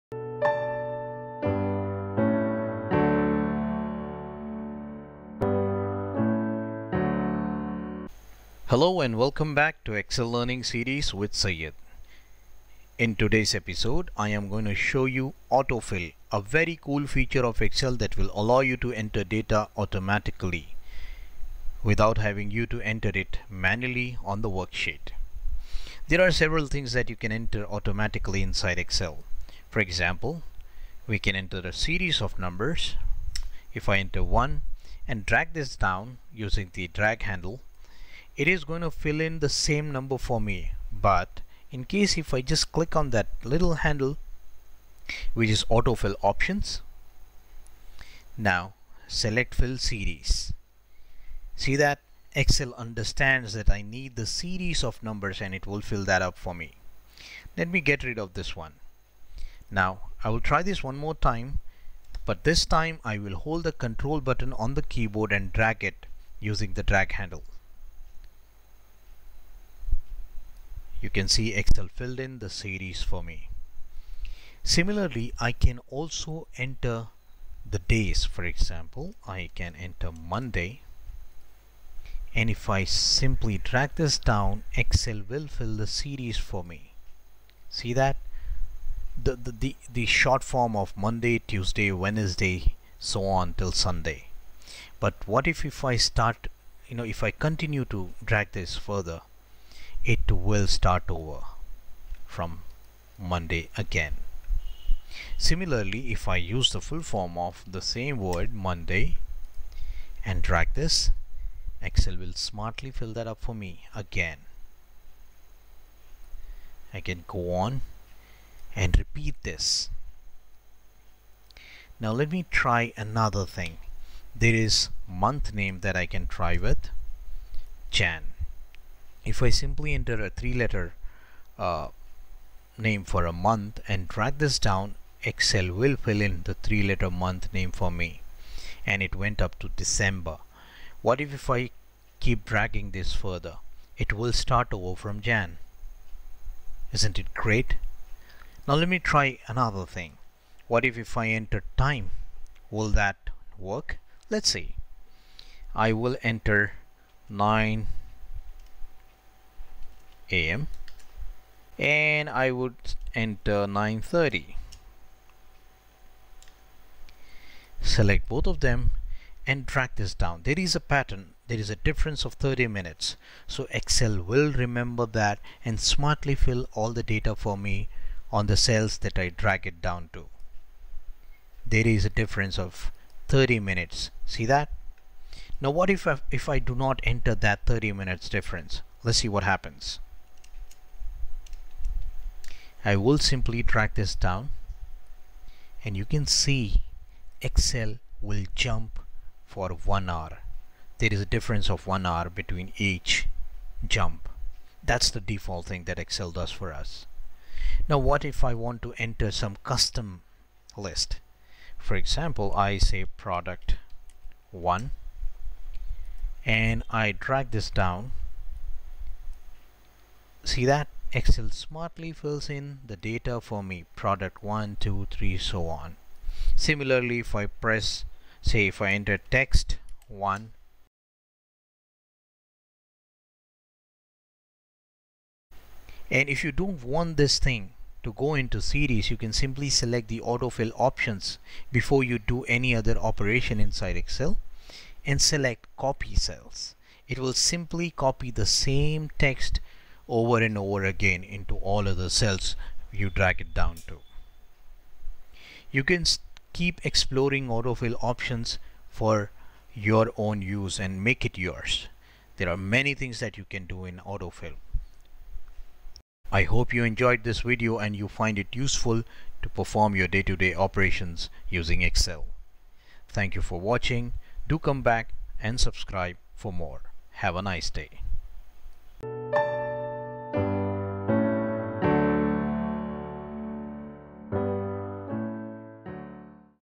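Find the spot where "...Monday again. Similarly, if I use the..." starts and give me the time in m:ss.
1:43.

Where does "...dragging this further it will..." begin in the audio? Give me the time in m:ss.
2:22.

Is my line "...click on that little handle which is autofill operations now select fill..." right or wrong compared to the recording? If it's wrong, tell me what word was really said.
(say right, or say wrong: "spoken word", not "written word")
wrong: "options", not "operations".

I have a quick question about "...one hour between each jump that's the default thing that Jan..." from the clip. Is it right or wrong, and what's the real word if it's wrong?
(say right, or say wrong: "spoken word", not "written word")
wrong: "Excel", not "Jan".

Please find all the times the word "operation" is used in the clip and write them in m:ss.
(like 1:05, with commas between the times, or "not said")
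4:02, 4:30.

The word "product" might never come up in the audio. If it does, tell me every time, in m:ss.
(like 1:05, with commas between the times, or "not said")
3:33, 3:43.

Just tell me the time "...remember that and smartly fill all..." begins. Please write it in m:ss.
2:54.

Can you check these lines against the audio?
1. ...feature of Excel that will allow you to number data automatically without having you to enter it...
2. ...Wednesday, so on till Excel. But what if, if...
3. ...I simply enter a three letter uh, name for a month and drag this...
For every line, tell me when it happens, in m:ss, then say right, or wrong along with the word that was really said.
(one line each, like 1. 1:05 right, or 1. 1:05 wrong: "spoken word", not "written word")
1. 0:17 wrong: "enter", not "number"
2. 1:31 wrong: "Sunday", not "Excel"
3. 2:09 right.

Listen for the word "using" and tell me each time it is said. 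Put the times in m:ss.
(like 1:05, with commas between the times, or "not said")
0:36, 1:06, 4:31.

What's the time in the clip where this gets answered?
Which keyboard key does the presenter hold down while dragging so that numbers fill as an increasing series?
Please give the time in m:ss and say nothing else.
1:03.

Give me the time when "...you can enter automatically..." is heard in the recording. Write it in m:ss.
0:27.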